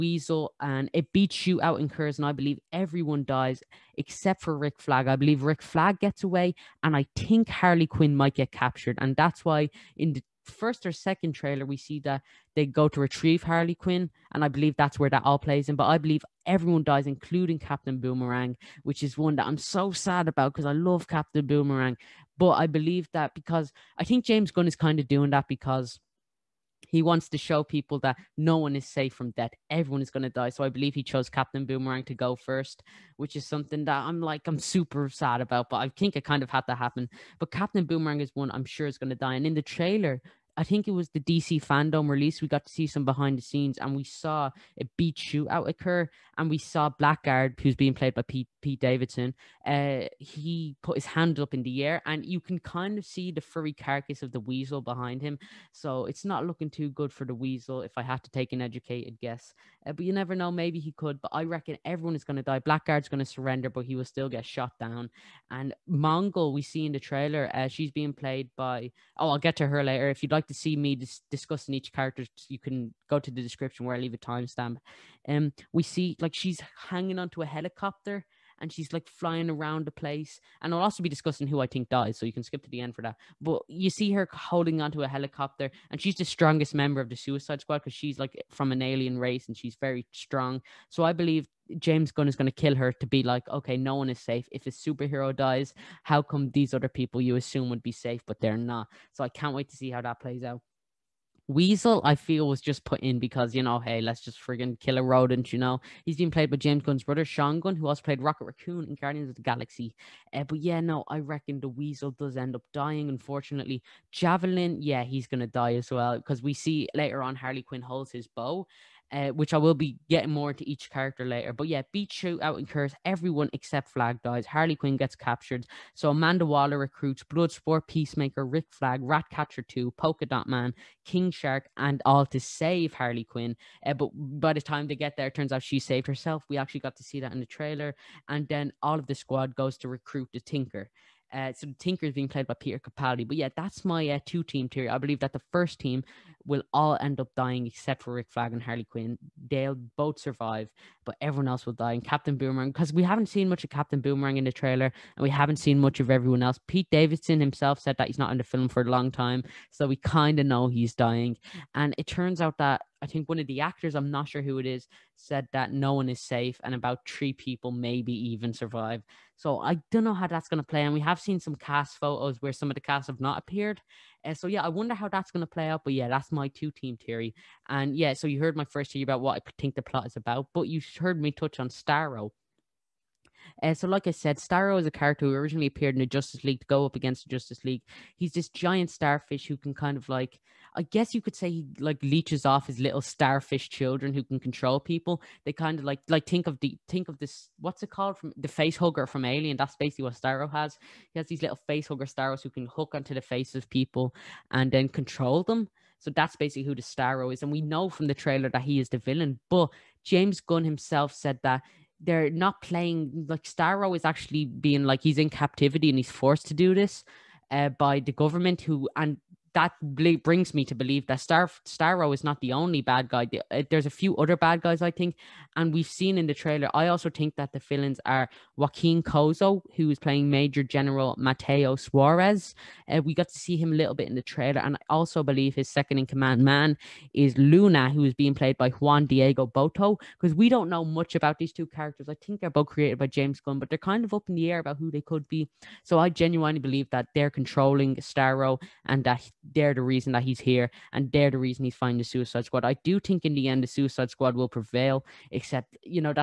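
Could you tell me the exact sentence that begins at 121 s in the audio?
But yeah, Beach Shootout incurs everyone except Flag dies.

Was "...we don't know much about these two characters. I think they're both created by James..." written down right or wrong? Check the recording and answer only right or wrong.
right.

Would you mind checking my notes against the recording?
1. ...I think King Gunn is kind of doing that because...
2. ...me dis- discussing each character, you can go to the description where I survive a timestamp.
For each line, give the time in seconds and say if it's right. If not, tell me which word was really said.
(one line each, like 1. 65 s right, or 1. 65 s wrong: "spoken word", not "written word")
1. 23 s wrong: "James", not "King"
2. 70 s wrong: "leave", not "survive".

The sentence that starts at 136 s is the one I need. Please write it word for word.
We actually got to see that in the trailer.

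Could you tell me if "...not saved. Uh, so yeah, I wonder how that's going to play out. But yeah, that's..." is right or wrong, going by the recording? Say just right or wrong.
wrong.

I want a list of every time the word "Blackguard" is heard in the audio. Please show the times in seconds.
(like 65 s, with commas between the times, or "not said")
46 s, 62 s.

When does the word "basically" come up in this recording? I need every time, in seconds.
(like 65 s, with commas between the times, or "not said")
199 s, 206 s.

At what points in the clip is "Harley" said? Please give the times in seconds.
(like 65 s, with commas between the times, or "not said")
7 s, 13 s, 117 s, 124 s, 132 s, 148 s.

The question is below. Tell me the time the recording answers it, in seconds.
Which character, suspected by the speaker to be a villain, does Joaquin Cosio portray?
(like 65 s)
230 s.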